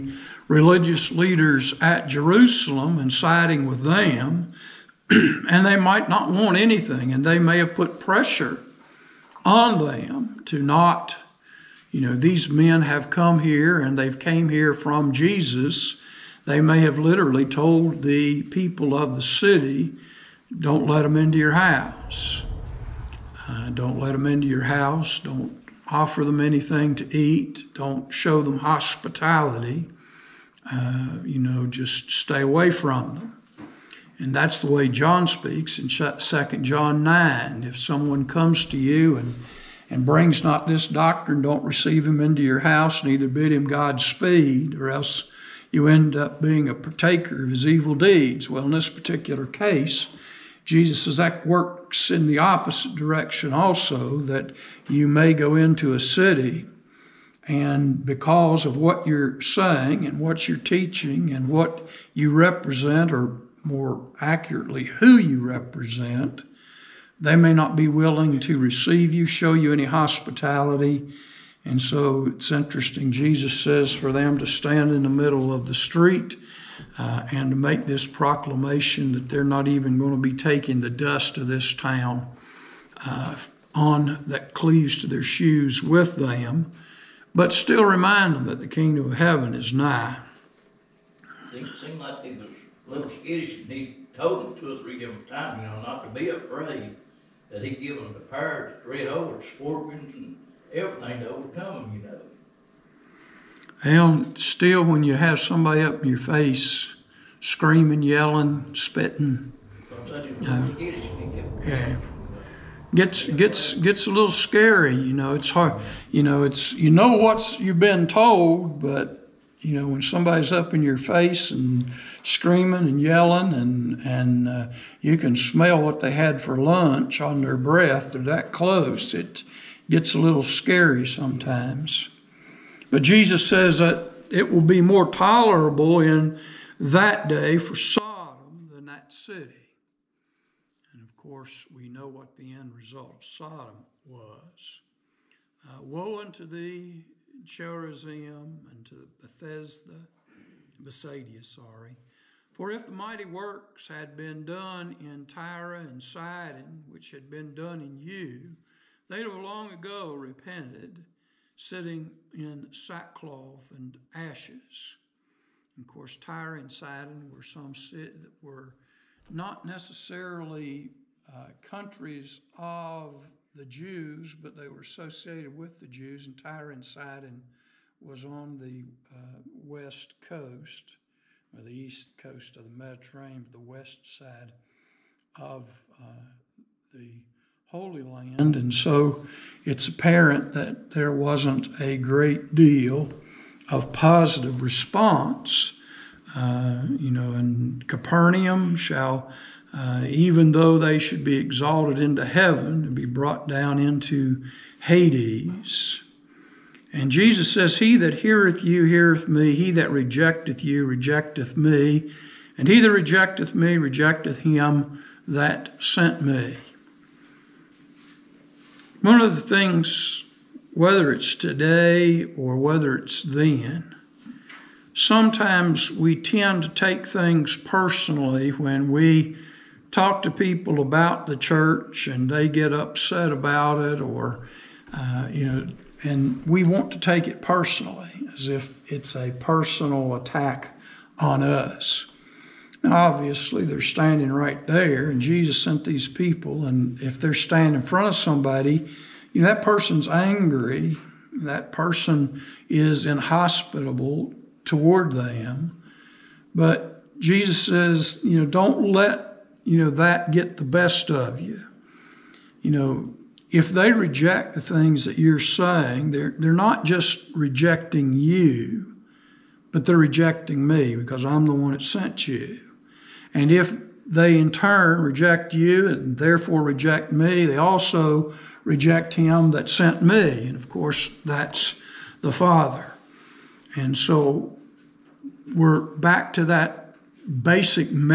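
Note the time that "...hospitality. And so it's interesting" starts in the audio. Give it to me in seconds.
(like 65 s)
69 s.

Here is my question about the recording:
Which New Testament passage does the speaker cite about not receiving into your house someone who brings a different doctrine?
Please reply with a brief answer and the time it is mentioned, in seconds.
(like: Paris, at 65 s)
2 John 9, at 35 s.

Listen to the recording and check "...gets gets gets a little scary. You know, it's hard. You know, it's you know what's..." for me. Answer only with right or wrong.
right.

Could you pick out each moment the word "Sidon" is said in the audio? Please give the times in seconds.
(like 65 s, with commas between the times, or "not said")
156 s, 166 s, 176 s.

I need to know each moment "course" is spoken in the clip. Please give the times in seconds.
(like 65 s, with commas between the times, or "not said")
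141 s, 165 s, 280 s.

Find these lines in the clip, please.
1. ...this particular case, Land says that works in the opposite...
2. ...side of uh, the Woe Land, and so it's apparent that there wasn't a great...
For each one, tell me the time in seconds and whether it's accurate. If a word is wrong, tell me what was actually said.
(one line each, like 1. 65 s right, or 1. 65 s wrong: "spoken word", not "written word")
1. 48 s wrong: "Jesus", not "Land"
2. 184 s wrong: "Holy", not "Woe".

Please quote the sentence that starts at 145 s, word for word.
Uh, Woe unto thee, Chorazin, and to Bethesda, Bethsaida, sorry.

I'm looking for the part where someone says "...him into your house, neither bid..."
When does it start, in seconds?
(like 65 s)
42 s.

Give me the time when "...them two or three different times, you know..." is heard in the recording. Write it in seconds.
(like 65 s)
94 s.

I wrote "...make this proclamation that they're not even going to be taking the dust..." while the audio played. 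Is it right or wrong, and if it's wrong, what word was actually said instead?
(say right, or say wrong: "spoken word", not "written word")
right.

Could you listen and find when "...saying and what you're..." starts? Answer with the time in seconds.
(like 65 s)
59 s.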